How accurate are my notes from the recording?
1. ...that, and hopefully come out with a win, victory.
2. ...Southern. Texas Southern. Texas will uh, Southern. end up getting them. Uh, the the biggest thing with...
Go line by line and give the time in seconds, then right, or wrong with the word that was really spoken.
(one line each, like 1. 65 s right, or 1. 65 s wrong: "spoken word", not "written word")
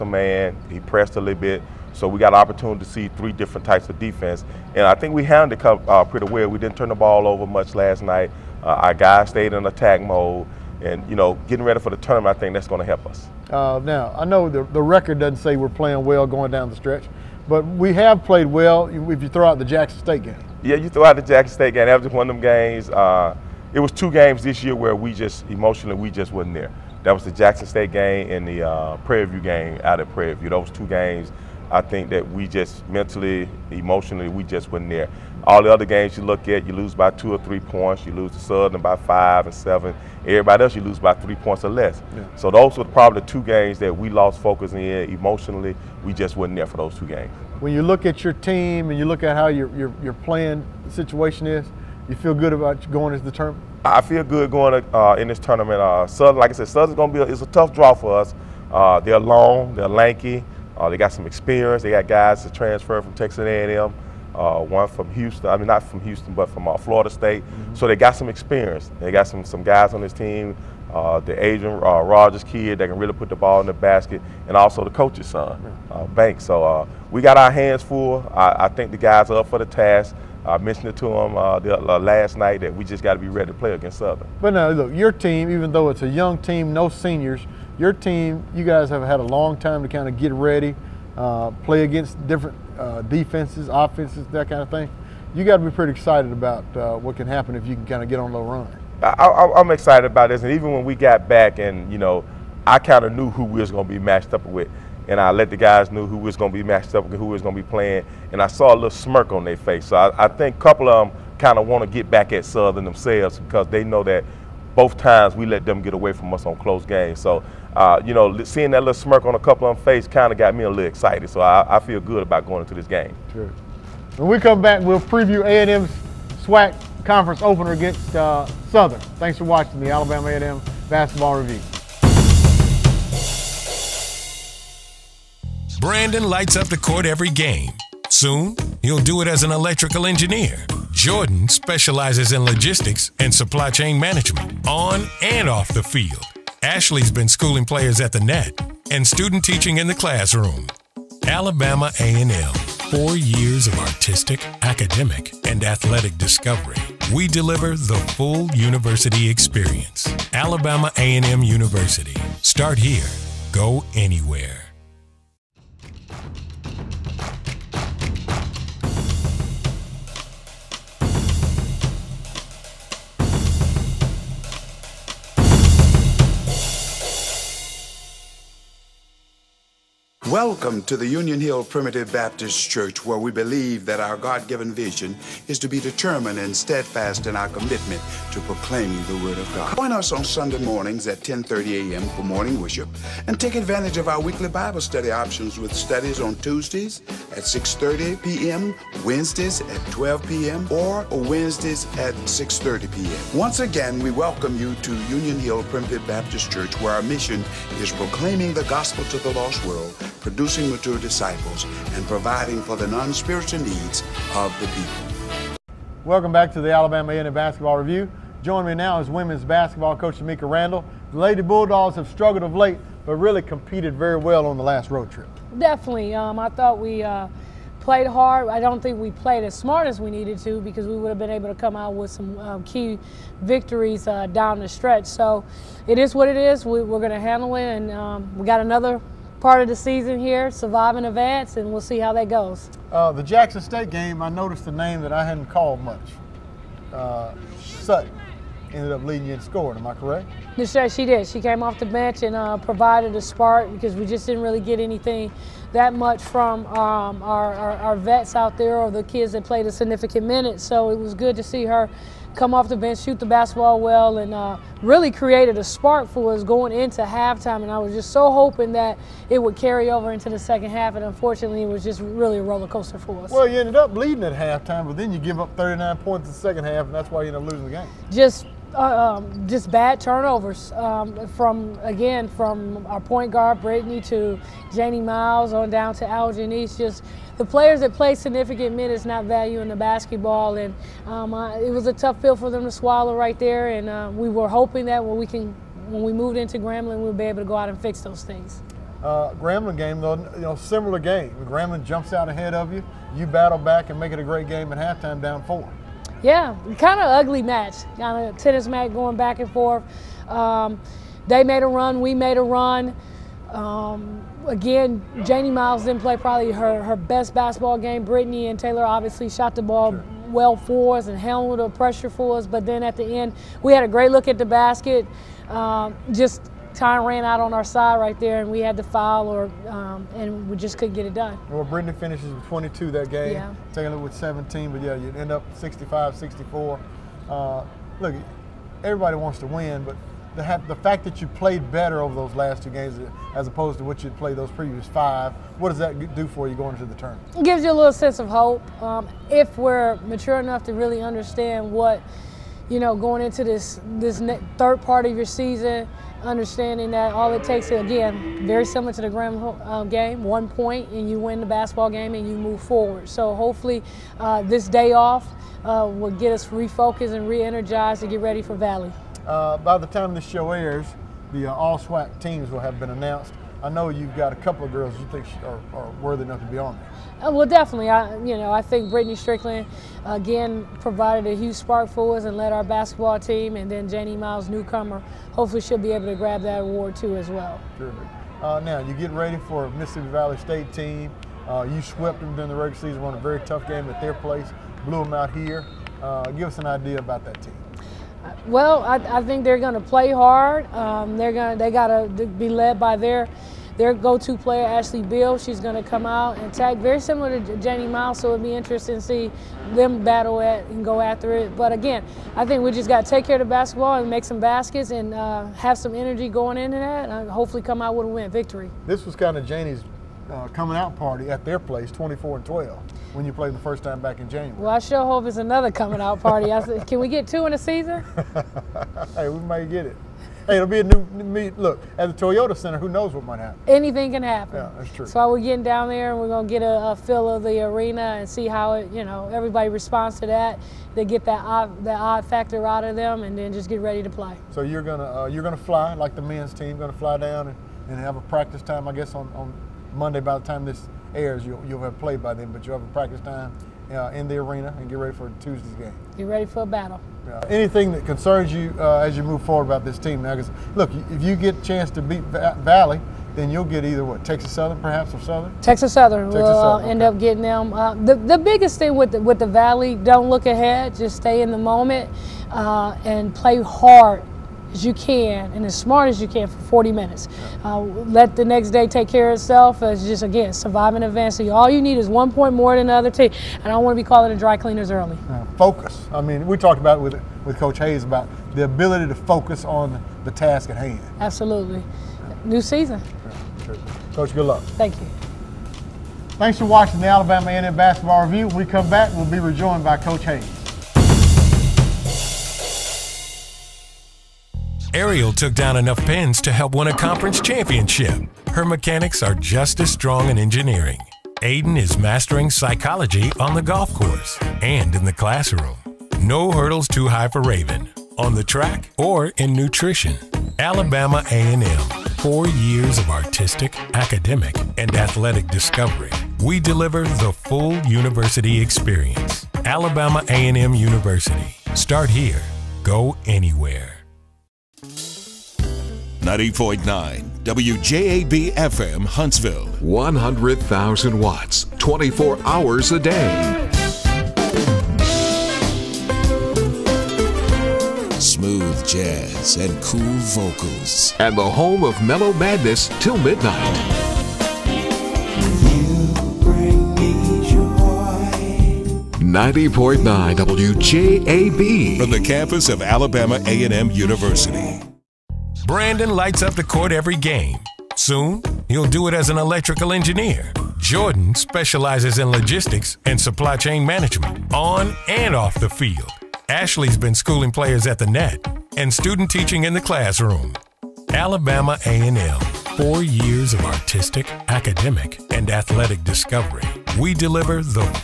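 1. 416 s right
2. 465 s right.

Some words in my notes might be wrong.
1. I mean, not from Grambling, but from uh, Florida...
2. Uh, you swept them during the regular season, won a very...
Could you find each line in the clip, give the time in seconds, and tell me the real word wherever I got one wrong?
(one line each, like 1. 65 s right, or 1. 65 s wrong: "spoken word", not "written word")
1. 65 s wrong: "Houston", not "Grambling"
2. 391 s right.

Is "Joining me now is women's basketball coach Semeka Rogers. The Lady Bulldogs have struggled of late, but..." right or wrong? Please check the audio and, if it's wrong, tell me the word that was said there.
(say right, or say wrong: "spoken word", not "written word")
wrong: "Randall", not "Rogers".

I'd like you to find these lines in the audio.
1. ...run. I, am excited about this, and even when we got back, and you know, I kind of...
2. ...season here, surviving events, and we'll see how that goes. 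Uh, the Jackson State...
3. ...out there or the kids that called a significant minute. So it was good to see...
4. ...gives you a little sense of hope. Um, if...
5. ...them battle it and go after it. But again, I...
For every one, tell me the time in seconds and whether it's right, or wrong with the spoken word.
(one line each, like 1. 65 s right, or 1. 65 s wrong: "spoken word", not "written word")
1. 98 s right
2. 239 s right
3. 258 s wrong: "played", not "called"
4. 347 s right
5. 409 s right.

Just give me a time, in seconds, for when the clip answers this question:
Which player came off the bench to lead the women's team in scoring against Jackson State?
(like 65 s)
247 s.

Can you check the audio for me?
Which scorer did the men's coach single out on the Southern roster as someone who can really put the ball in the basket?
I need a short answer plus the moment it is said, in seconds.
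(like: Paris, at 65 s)
Adrian Rogers, at 71 s.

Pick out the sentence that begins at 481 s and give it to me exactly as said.
So all you need is one point more than the other team.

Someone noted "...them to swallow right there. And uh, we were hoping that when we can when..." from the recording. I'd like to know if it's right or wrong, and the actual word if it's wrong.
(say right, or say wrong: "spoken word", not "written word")
right.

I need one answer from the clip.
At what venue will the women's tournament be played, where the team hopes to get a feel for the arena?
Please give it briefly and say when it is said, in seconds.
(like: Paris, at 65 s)
Toyota Center, at 432 s.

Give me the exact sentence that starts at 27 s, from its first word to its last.
That was the Jackson State game and the uh, Prairie View game out at Prairie View.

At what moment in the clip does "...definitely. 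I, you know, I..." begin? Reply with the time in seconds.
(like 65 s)
377 s.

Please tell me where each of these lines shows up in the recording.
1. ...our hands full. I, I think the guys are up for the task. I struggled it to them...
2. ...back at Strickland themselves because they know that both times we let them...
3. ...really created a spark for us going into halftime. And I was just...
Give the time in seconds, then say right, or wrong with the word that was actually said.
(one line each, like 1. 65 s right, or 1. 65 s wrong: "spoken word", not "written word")
1. 77 s wrong: "mentioned", not "struggled"
2. 112 s wrong: "Southern", not "Strickland"
3. 264 s right.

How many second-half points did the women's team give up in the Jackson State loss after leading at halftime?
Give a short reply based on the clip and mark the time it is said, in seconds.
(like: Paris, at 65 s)
39, at 275 s.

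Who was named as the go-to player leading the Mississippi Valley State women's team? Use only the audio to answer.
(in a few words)
Ashley Bill.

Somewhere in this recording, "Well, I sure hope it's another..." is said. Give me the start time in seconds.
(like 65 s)
424 s.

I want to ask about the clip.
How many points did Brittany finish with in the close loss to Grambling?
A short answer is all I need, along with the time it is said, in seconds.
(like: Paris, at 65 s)
22, at 332 s.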